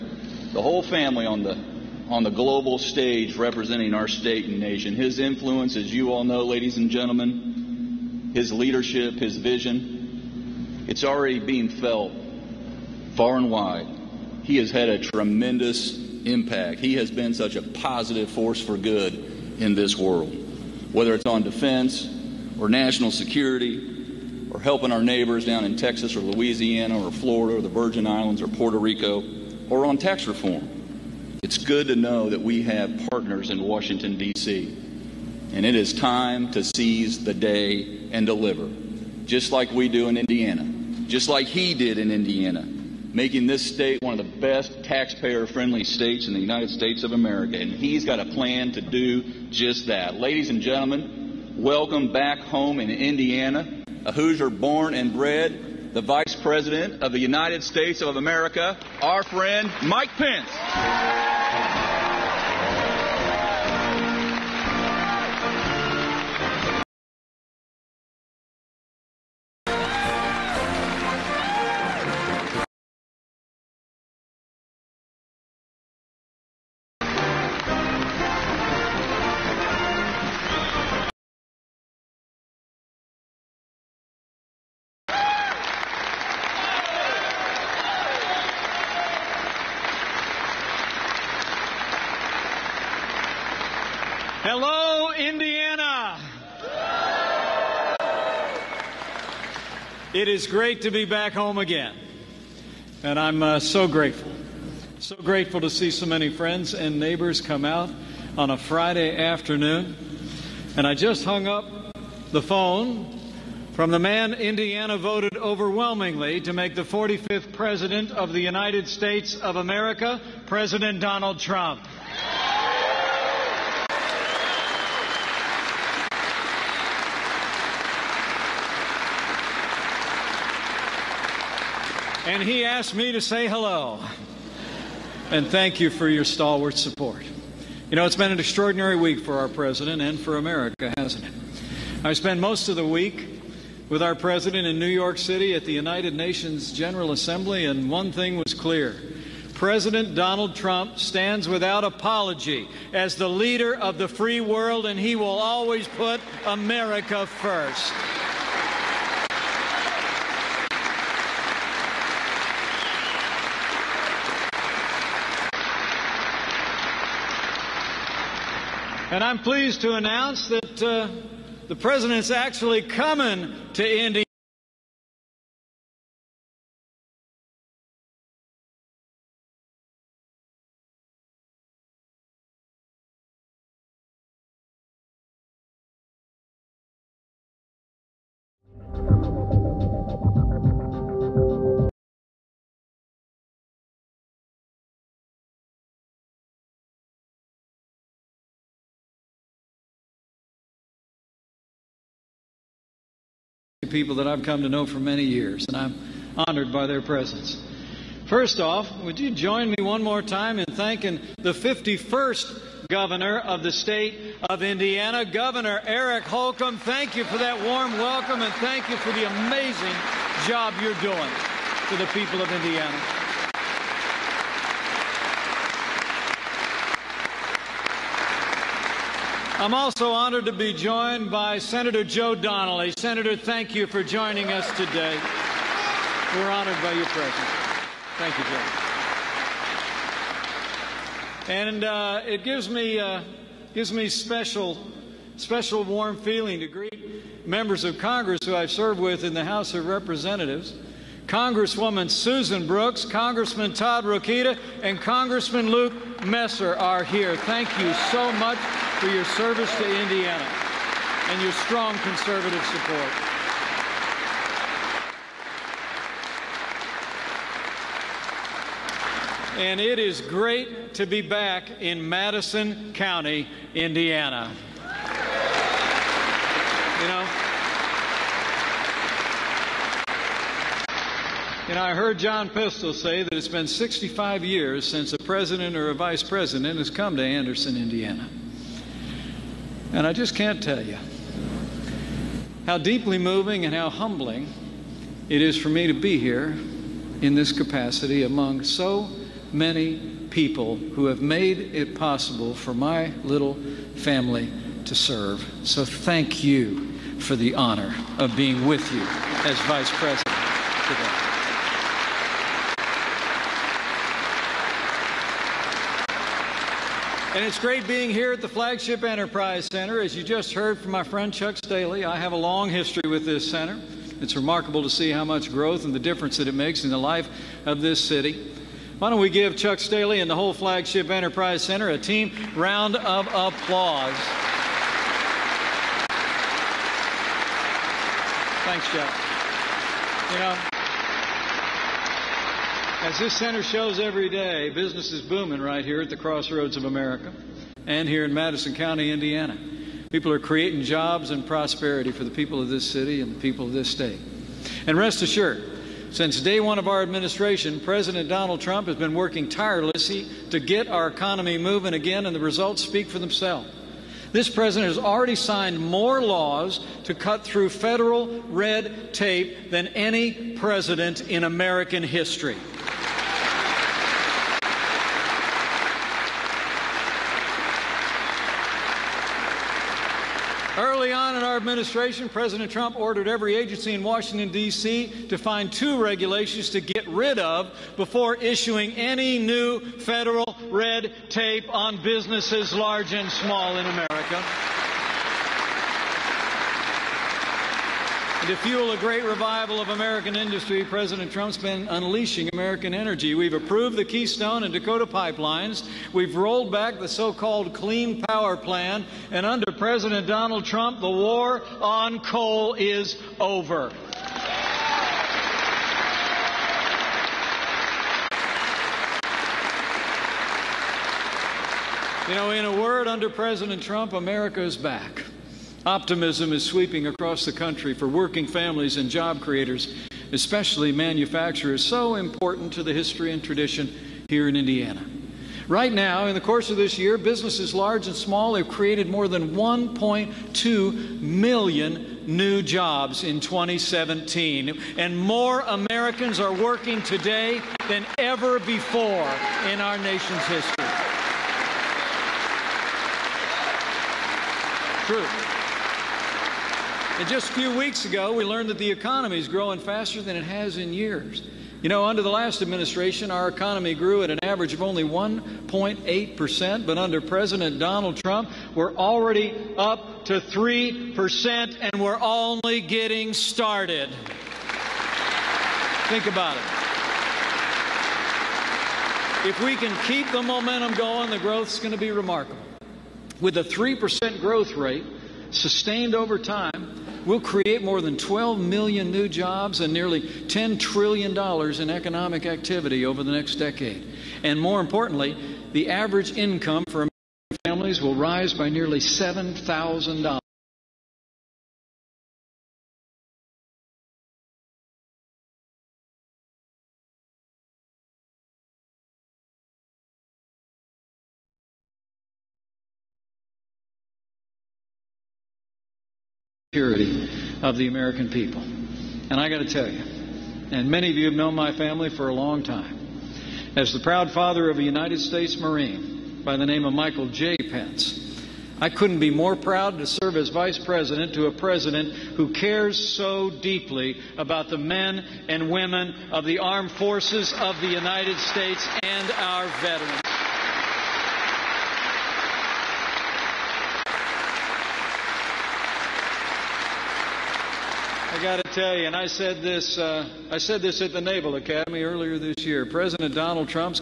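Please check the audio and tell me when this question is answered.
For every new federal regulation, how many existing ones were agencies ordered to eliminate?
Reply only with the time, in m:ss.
6:25.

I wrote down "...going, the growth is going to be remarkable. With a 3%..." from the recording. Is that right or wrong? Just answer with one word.
right.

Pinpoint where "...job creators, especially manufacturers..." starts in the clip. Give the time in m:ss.
7:09.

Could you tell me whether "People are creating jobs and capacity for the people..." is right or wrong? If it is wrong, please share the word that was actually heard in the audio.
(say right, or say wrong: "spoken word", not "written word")
wrong: "prosperity", not "capacity".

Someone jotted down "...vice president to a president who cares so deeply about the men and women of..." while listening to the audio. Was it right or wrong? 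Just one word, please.
right.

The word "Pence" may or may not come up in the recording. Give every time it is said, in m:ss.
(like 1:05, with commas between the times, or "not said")
1:00, 8:47.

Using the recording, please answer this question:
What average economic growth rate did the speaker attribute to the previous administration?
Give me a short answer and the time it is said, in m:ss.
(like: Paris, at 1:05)
1.8%, at 7:45.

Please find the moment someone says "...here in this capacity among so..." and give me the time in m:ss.
4:56.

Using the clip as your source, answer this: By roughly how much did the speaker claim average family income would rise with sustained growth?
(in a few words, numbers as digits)
$7,000.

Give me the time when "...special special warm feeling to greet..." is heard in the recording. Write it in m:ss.
4:04.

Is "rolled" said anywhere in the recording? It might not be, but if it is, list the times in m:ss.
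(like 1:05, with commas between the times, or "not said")
6:46.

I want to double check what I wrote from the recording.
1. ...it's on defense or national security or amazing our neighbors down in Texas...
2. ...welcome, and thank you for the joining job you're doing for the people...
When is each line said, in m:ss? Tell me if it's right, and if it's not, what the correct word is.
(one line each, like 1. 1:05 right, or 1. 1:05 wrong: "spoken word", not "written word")
1. 0:21 wrong: "helping", not "amazing"
2. 3:37 wrong: "amazing", not "joining".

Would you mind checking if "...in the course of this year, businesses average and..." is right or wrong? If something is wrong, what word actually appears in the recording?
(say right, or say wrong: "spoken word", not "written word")
wrong: "large", not "average".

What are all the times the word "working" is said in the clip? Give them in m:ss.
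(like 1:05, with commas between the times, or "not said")
5:59, 7:08, 7:26.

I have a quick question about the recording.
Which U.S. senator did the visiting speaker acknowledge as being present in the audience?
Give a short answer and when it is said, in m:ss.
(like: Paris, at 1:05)
Joe Donnelly, at 3:51.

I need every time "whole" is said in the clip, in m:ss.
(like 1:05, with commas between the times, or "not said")
0:00, 5:30.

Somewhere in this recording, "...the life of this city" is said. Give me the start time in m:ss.
5:26.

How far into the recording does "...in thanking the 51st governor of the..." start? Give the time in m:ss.
3:30.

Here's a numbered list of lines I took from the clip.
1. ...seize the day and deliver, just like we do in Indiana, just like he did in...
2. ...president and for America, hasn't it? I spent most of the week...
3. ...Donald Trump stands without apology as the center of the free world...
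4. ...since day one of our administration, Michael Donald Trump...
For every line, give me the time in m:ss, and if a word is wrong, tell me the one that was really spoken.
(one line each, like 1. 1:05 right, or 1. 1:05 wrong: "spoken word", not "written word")
1. 0:36 right
2. 2:19 right
3. 2:30 wrong: "leader", not "center"
4. 5:56 wrong: "President", not "Michael".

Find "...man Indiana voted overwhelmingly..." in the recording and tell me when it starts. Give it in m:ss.
1:53.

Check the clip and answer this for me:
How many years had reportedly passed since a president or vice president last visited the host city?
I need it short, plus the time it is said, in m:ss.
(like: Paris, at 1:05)
65, at 4:43.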